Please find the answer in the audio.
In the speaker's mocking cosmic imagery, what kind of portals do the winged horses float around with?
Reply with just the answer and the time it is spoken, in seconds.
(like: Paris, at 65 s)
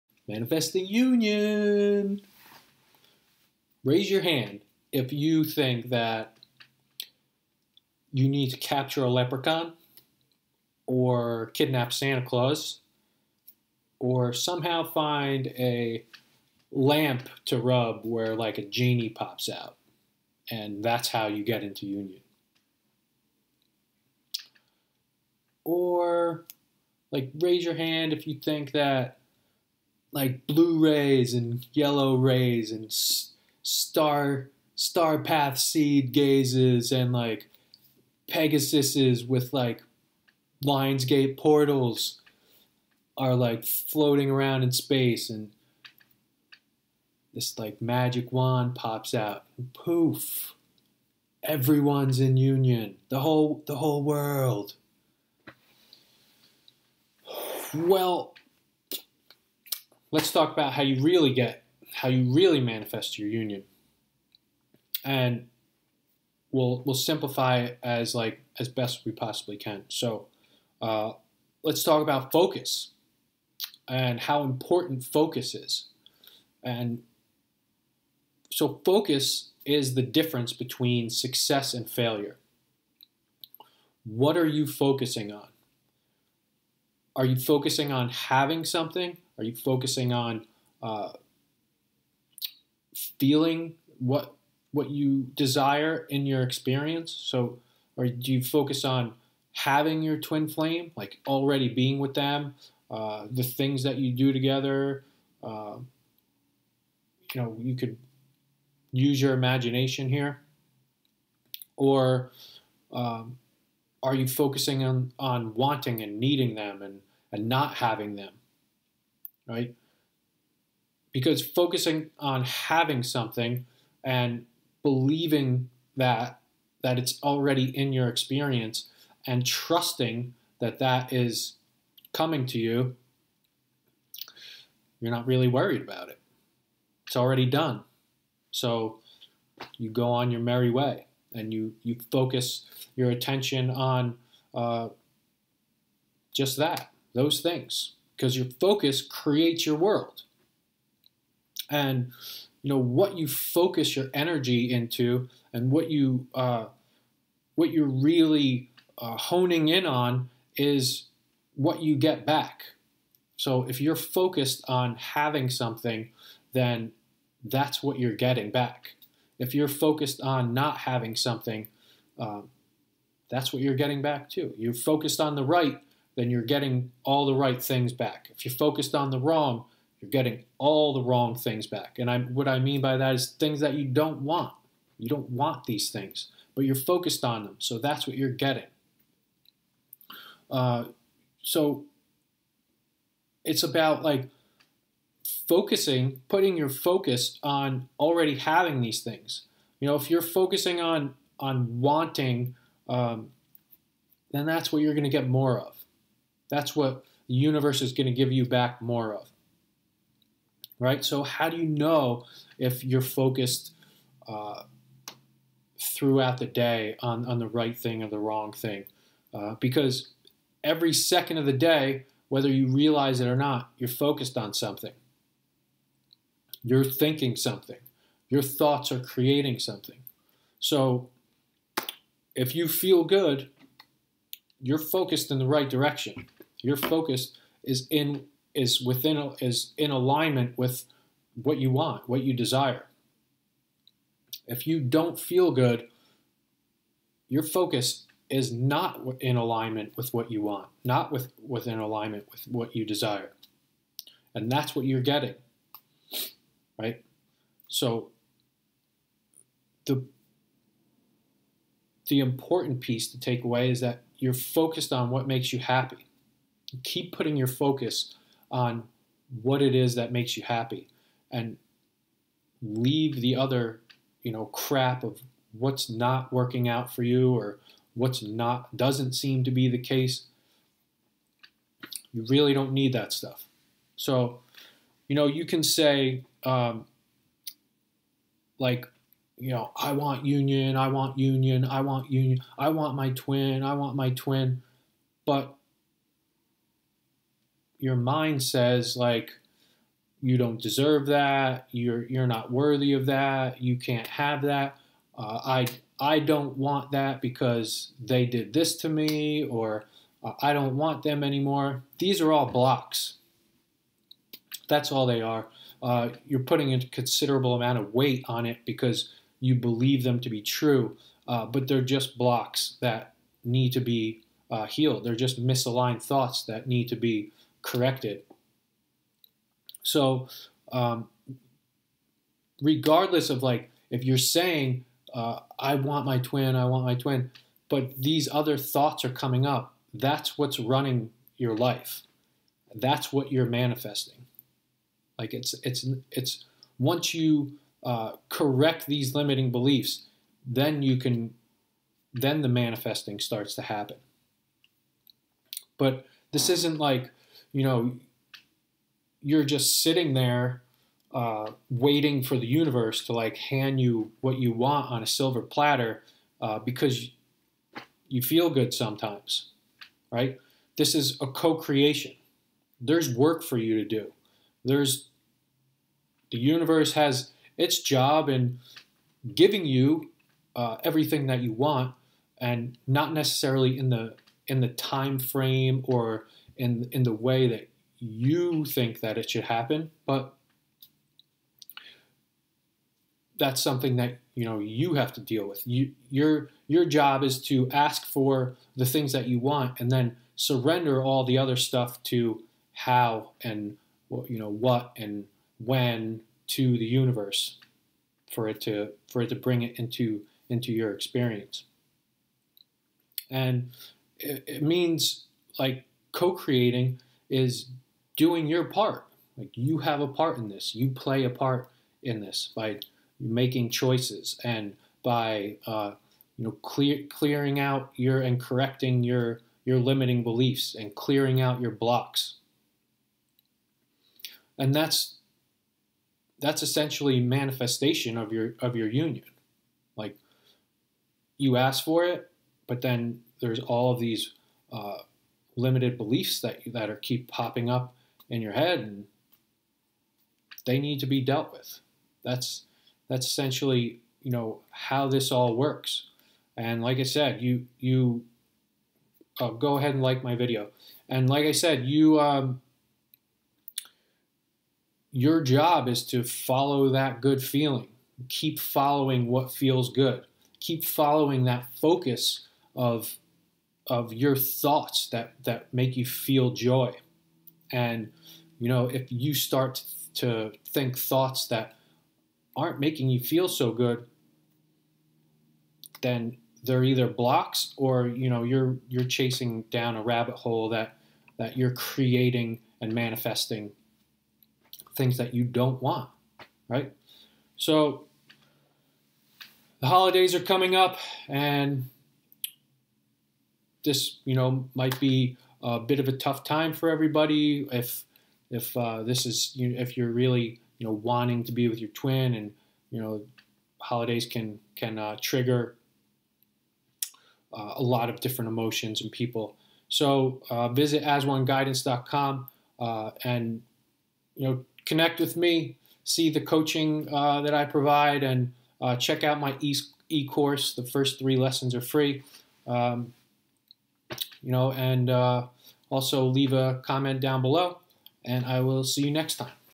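Lionsgate portals, at 40 s.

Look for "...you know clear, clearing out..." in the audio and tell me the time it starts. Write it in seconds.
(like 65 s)
426 s.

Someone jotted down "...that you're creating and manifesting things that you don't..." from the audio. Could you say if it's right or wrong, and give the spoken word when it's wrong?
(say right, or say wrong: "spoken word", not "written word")
right.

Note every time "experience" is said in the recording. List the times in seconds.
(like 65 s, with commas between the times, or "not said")
96 s, 128 s, 410 s.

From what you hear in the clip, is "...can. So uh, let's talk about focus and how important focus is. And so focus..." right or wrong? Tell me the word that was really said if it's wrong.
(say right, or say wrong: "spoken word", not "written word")
right.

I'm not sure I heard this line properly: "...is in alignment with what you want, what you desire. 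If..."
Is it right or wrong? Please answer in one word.
right.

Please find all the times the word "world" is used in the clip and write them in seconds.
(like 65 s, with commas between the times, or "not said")
54 s, 149 s.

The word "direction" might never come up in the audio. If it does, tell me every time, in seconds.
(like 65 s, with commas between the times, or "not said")
235 s.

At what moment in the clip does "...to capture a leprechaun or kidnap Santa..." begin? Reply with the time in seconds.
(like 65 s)
8 s.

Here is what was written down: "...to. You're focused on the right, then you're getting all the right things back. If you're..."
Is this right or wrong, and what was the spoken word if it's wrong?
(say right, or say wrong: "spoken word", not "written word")
right.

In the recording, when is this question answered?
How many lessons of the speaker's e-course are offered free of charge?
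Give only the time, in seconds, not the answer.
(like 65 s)
531 s.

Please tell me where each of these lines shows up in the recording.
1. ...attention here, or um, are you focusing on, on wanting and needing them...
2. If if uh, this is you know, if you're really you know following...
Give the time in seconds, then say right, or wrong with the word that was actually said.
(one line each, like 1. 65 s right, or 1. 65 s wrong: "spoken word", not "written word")
1. 109 s wrong: "imagination", not "attention"
2. 507 s wrong: "wanting", not "following".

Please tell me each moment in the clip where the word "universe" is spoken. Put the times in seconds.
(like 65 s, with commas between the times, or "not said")
207 s, 362 s, 376 s, 406 s.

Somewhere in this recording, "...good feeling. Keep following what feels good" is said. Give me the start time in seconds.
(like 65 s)
467 s.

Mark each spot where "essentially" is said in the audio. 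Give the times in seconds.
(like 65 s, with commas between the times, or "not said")
436 s, 453 s.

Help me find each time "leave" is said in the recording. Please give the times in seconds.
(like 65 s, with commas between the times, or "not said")
272 s, 536 s.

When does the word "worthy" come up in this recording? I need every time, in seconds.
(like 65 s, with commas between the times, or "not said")
302 s.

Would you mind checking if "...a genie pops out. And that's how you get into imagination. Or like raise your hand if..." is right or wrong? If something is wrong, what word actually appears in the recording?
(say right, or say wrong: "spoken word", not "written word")
wrong: "union", not "imagination".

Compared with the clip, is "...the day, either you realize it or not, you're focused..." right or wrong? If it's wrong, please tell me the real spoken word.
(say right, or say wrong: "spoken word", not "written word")
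wrong: "whether", not "either".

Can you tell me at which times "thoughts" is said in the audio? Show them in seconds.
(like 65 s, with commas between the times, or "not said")
228 s, 326 s, 338 s, 474 s, 480 s.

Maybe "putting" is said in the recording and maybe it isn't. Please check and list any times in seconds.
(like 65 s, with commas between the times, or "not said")
196 s, 267 s, 316 s.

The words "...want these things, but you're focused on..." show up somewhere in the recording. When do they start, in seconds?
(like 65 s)
185 s.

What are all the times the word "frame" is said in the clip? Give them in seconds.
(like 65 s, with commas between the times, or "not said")
385 s.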